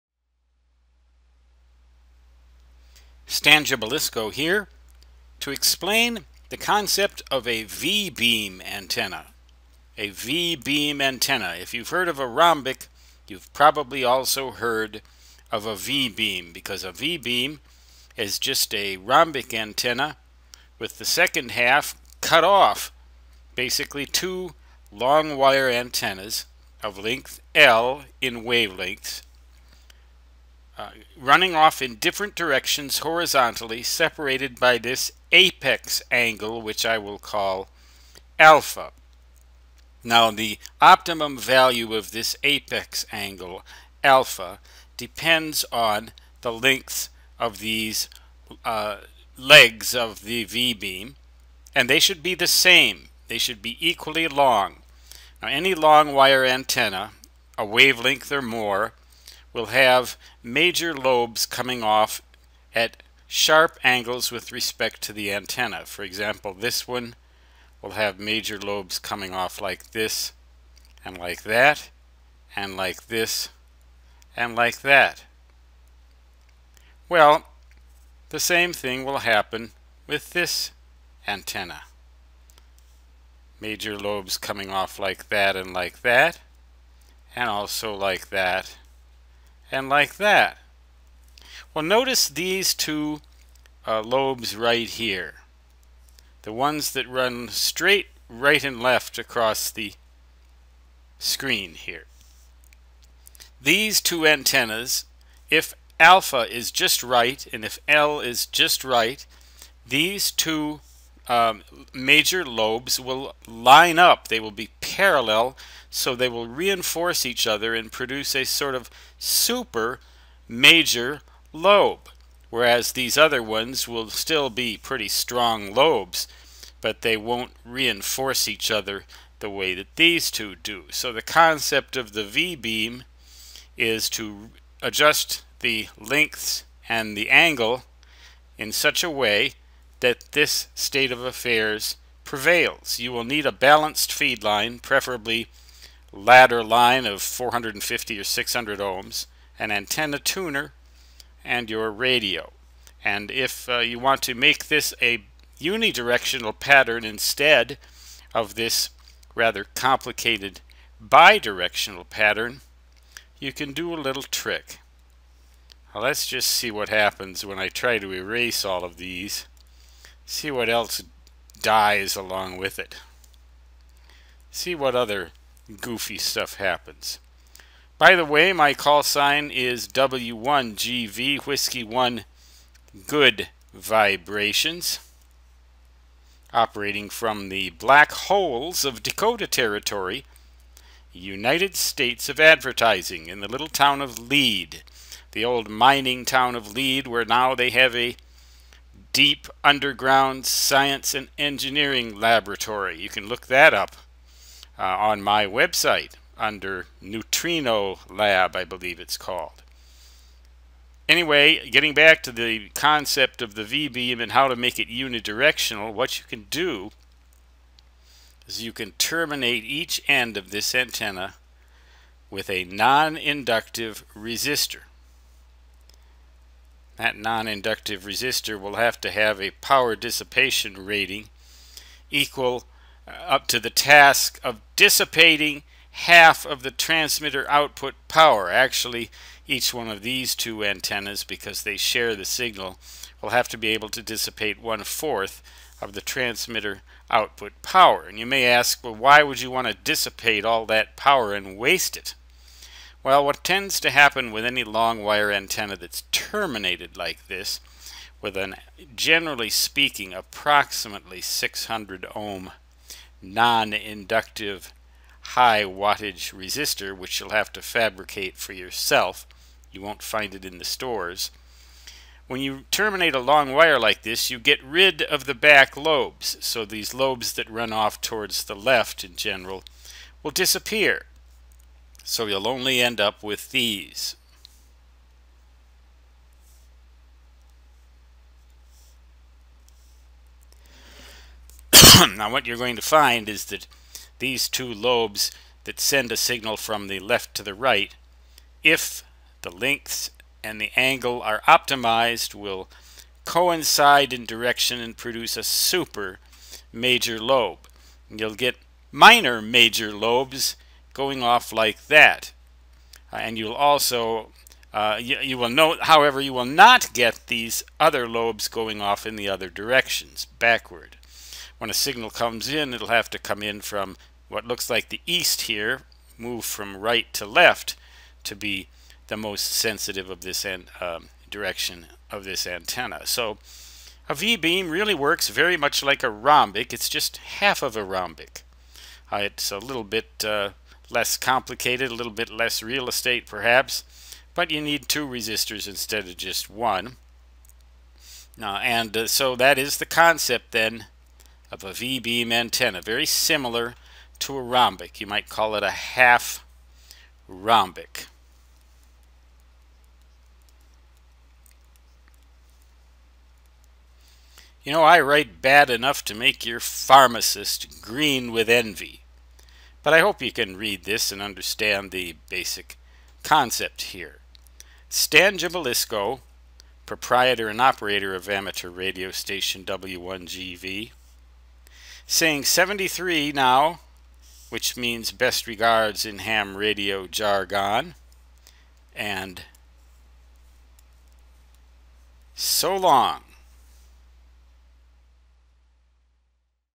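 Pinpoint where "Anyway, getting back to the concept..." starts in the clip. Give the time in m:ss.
3:31.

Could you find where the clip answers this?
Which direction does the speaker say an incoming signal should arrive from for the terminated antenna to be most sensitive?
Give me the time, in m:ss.
5:25.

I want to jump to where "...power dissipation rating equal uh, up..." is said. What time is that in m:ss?
3:49.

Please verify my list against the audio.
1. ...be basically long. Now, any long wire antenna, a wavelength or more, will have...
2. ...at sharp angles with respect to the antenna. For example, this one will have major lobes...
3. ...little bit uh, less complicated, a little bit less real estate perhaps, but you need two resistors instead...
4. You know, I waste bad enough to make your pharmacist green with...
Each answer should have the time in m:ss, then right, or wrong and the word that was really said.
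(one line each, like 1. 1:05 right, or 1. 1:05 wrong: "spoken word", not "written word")
1. 0:53 wrong: "equally", not "basically"
2. 1:02 right
3. 5:39 right
4. 6:04 wrong: "write", not "waste".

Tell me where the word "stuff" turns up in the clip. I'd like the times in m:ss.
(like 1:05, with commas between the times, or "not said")
2:56.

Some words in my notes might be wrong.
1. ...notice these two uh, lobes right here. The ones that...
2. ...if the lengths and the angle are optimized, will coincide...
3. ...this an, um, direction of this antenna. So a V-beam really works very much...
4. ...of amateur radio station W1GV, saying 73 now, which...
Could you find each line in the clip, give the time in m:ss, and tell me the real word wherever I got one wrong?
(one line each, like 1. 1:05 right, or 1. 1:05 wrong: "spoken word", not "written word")
1. 1:31 right
2. 4:58 right
3. 5:30 right
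4. 6:18 right.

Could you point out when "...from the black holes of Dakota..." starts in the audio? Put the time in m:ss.
3:07.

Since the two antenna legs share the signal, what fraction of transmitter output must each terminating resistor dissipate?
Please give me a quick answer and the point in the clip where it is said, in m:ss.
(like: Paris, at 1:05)
One-fourth, at 4:04.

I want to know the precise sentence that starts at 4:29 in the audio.
You won't find it in the stores.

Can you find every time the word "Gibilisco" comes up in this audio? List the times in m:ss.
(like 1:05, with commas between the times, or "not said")
0:03, 6:15.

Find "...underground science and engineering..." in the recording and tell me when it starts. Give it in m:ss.
3:19.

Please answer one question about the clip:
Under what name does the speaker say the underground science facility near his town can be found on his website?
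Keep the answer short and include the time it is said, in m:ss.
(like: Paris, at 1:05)
Neutrino Lab, at 3:27.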